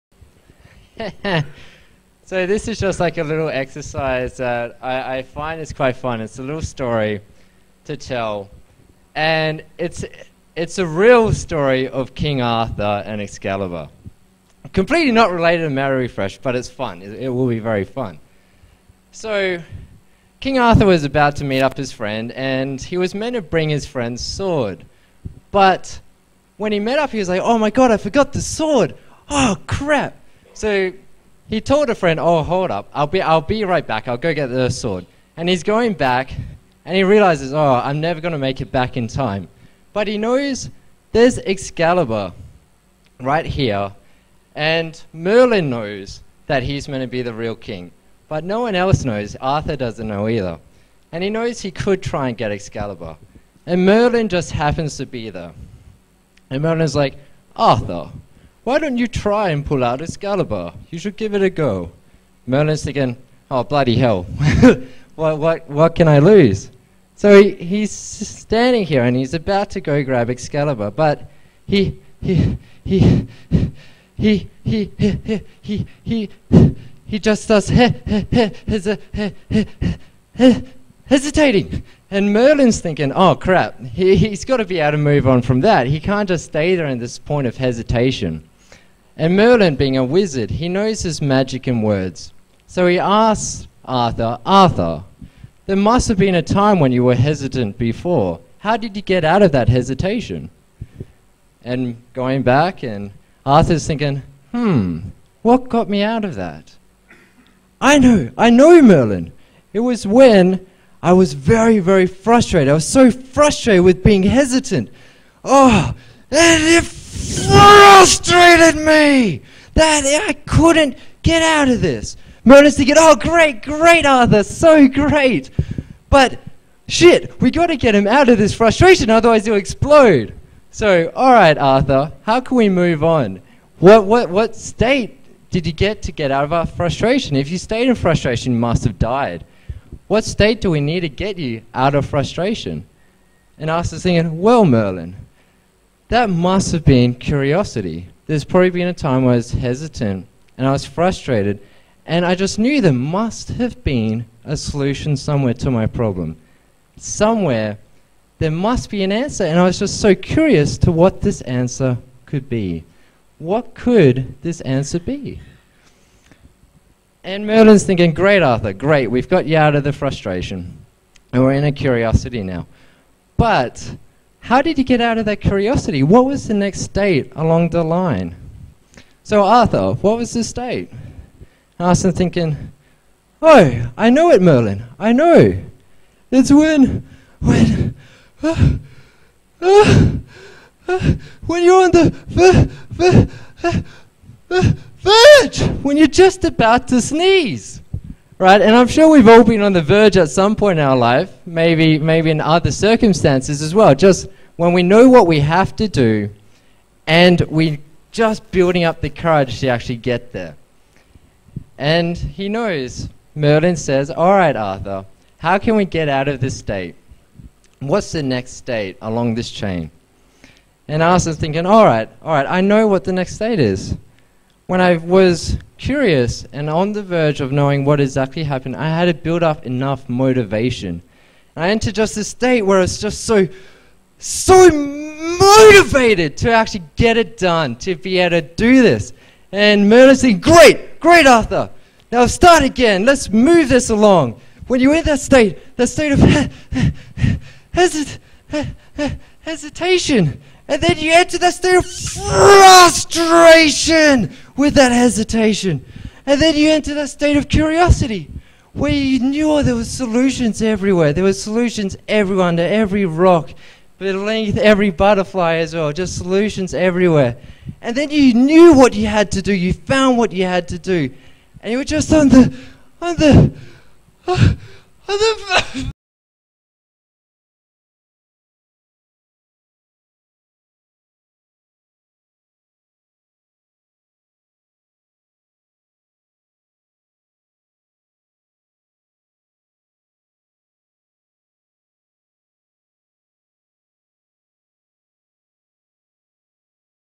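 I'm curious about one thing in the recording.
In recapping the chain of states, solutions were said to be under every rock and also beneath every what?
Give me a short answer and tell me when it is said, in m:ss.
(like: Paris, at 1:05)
Butterfly, at 4:24.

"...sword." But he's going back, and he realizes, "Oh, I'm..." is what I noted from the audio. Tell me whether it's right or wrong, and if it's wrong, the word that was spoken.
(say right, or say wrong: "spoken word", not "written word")
wrong: "And", not "But".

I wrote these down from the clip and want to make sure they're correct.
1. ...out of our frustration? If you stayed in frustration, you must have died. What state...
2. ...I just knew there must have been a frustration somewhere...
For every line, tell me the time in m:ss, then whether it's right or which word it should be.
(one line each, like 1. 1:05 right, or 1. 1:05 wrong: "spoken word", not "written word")
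1. 2:16 right
2. 2:32 wrong: "solution", not "frustration".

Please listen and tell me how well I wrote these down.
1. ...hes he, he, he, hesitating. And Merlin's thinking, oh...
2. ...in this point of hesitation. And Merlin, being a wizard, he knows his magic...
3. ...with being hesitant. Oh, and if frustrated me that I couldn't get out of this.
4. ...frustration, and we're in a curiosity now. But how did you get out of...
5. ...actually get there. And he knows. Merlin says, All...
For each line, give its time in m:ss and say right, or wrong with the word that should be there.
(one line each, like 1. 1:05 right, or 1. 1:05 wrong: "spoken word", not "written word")
1. 1:18 right
2. 1:26 right
3. 1:53 right
4. 2:49 right
5. 3:29 right.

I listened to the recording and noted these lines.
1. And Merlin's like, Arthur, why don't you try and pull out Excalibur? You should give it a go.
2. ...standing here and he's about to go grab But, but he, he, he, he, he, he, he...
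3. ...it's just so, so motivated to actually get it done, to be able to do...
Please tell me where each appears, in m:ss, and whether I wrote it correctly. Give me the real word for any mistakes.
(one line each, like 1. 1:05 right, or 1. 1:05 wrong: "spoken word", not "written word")
1. 0:56 right
2. 1:07 wrong: "Excalibur", not "But"
3. 3:52 right.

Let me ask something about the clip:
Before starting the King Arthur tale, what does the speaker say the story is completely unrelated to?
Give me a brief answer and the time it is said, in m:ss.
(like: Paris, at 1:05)
Meta Refresh, at 0:15.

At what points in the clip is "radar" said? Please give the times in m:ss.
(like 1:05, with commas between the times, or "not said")
not said.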